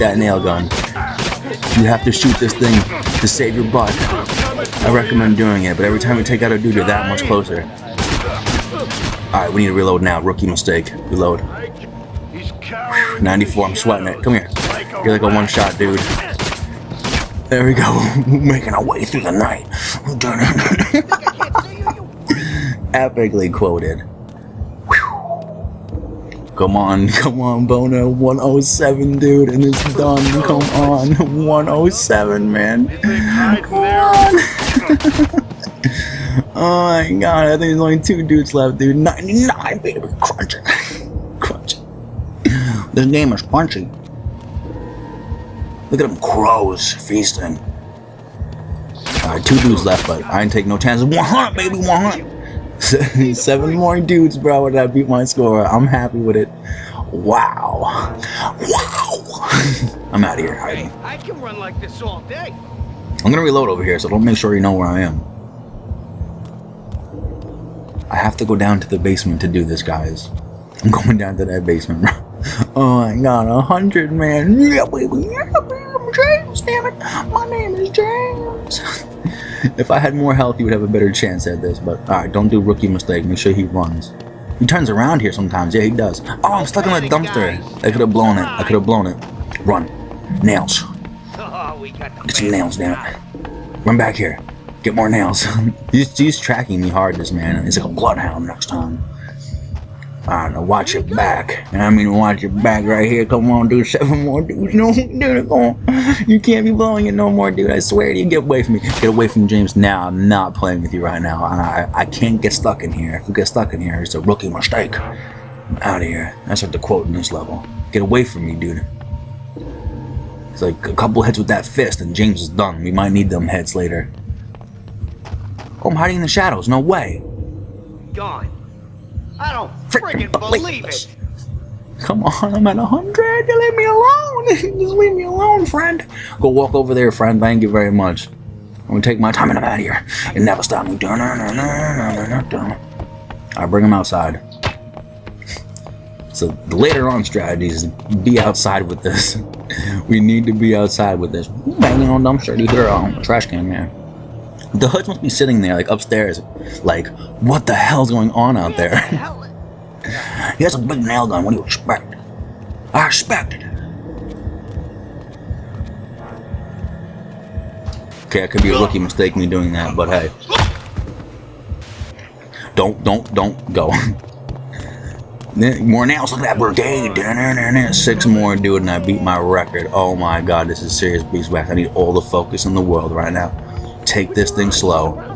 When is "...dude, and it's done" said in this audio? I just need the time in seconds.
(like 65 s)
29 s.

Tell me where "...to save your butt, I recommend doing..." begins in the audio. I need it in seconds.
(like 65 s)
3 s.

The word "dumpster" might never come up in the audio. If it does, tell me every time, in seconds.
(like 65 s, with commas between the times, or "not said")
87 s, 152 s.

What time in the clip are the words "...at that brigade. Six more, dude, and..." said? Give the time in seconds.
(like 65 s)
176 s.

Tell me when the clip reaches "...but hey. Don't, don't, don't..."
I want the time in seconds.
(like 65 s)
169 s.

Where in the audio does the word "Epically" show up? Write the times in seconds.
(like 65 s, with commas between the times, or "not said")
22 s.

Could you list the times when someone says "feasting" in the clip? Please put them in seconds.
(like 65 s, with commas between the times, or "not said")
46 s.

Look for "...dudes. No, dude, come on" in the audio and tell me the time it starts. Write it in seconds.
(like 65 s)
104 s.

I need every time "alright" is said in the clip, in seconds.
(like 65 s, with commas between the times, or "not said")
9 s, 49 s, 82 s.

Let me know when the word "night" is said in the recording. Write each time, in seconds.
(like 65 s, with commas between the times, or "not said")
19 s.